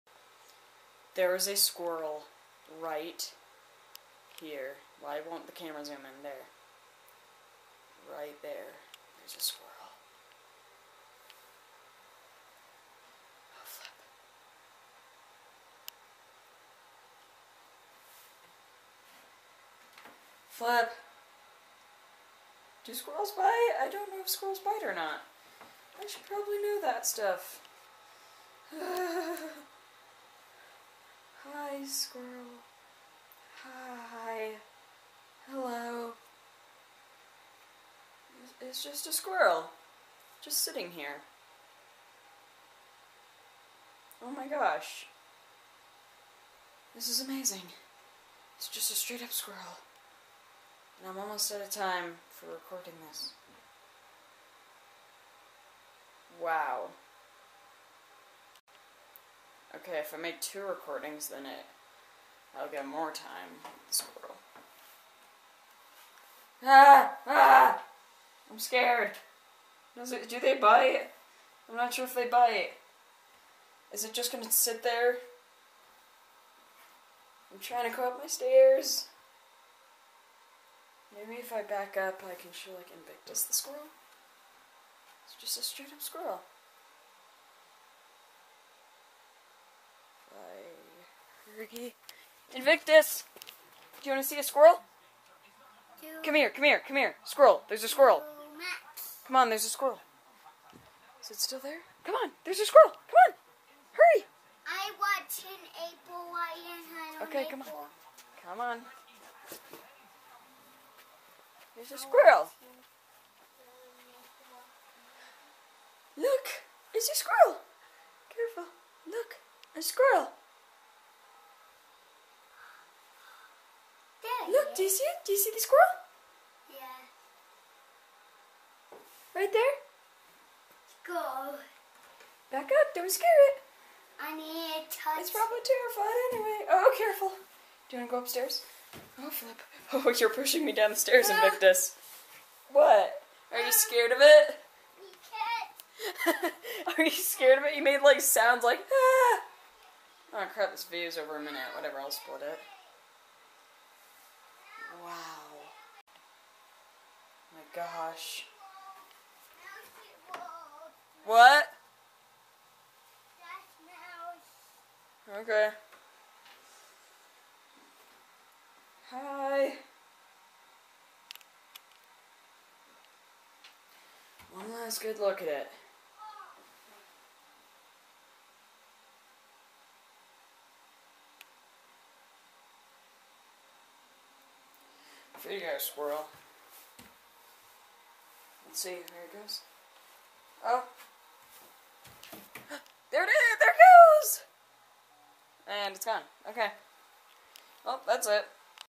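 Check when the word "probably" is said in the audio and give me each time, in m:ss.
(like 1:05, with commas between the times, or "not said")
0:26, 2:15.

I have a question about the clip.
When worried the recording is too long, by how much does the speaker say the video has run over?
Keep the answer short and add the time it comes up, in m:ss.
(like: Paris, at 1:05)
a minute, at 2:31.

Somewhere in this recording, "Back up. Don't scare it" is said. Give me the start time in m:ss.
2:12.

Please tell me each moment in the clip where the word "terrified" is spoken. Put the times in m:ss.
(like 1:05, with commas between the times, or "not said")
2:15.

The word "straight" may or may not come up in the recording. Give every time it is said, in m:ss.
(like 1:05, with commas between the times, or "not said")
0:48, 1:25.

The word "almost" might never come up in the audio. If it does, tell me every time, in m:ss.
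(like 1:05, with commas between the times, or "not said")
0:51.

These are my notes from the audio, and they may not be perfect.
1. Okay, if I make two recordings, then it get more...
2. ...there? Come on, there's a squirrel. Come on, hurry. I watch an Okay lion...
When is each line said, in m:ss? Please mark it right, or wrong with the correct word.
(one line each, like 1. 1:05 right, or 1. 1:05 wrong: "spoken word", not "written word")
1. 0:59 right
2. 1:41 wrong: "April", not "Okay".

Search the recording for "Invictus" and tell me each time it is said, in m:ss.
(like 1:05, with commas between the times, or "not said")
1:22, 1:32, 2:21.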